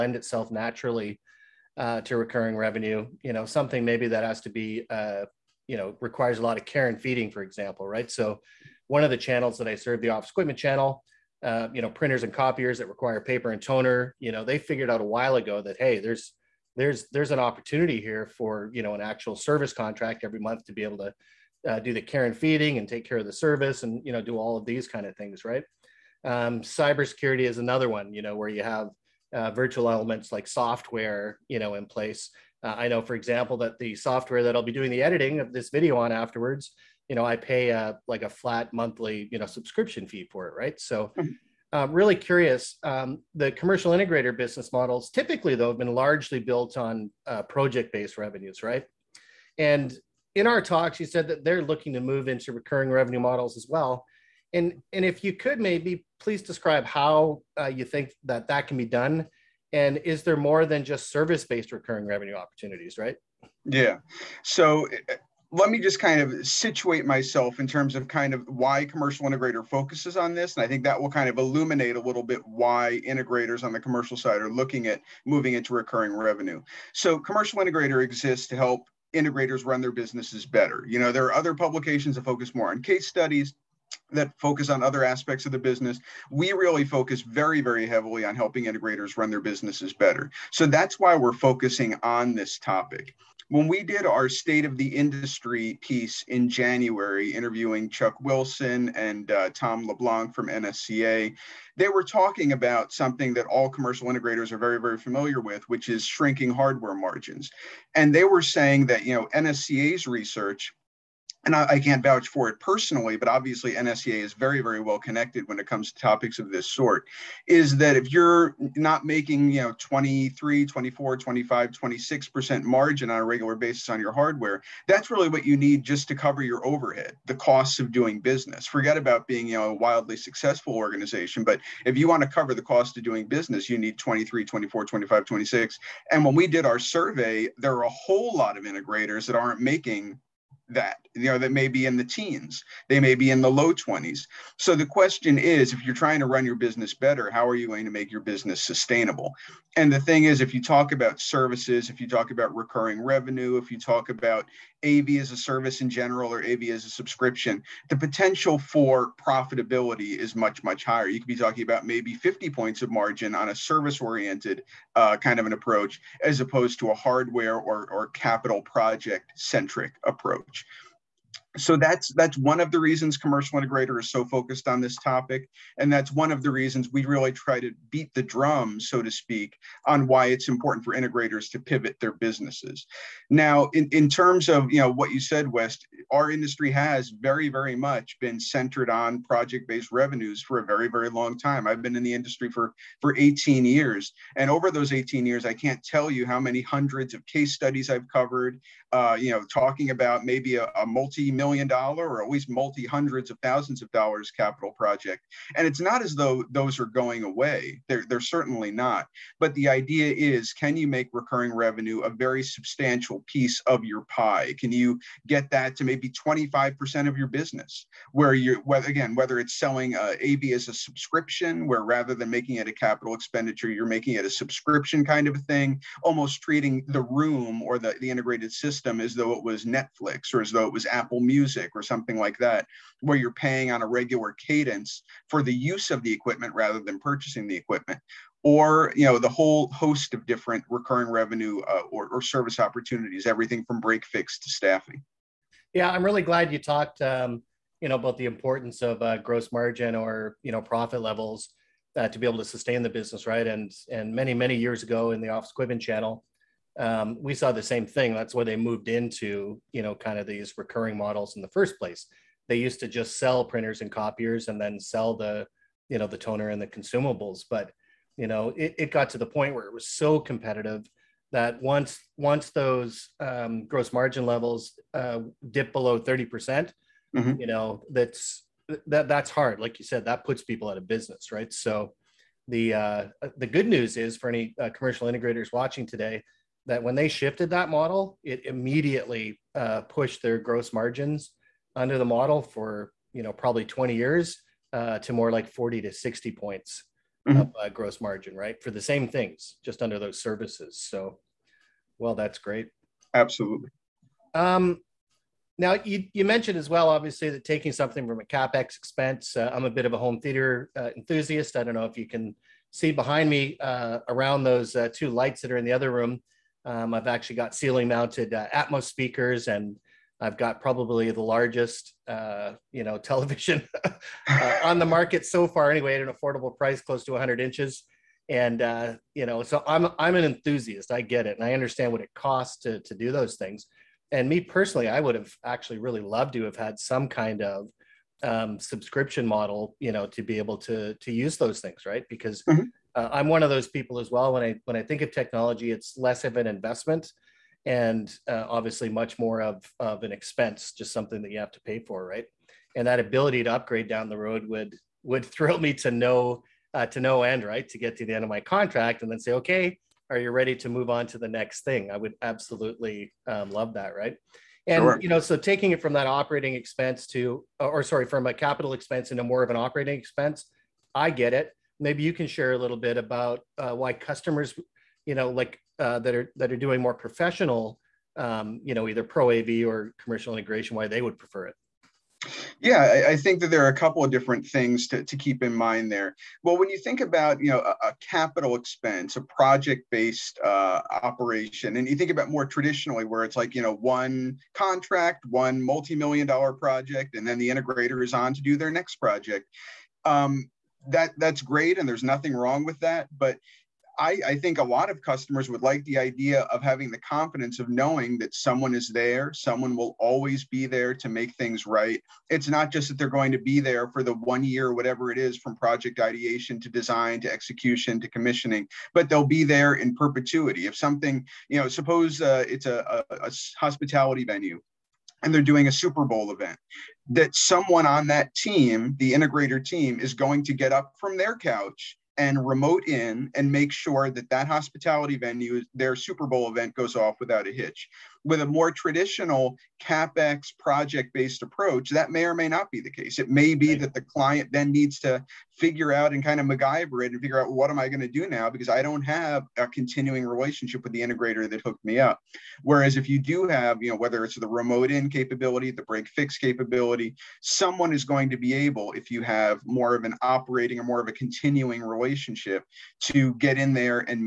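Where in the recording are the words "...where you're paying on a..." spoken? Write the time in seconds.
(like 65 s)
232 s.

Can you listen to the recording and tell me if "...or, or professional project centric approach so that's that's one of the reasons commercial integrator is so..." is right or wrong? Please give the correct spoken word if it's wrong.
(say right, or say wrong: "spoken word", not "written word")
wrong: "capital", not "professional".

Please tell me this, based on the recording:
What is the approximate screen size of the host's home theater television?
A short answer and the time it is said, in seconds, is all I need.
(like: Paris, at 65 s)
100 inches, at 327 s.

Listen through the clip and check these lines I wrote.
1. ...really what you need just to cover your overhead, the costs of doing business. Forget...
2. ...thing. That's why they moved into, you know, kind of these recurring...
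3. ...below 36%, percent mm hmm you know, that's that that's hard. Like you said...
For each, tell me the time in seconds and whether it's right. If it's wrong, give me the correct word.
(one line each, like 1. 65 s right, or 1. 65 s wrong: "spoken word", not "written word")
1. 125 s right
2. 257 s right
3. 275 s wrong: "30", not "36".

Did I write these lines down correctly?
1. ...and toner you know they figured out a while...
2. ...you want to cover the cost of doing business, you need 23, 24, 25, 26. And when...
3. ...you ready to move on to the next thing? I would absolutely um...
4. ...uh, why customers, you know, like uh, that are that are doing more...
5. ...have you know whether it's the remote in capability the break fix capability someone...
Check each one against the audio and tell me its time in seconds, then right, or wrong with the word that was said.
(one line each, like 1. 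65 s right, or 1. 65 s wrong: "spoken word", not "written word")
1. 13 s right
2. 131 s right
3. 360 s right
4. 373 s right
5. 453 s right.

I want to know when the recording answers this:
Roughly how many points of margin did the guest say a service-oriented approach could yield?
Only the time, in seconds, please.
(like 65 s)
162 s.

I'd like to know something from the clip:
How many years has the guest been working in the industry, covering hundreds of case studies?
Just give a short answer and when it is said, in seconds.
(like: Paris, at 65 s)
18, at 191 s.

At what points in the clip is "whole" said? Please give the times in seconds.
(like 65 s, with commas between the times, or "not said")
137 s, 239 s.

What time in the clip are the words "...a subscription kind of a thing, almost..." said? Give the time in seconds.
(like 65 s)
224 s.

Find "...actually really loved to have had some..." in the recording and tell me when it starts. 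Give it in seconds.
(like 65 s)
335 s.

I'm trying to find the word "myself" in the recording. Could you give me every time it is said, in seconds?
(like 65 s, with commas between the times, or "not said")
67 s.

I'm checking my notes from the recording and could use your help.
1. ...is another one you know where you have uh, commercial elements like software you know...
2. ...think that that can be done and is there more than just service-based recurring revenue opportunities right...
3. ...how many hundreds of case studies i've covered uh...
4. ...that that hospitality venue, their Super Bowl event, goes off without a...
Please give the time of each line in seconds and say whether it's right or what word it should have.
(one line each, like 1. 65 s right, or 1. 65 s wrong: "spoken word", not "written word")
1. 27 s wrong: "virtual", not "commercial"
2. 57 s right
3. 196 s right
4. 434 s right.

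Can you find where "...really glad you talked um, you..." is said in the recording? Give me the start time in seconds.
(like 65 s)
246 s.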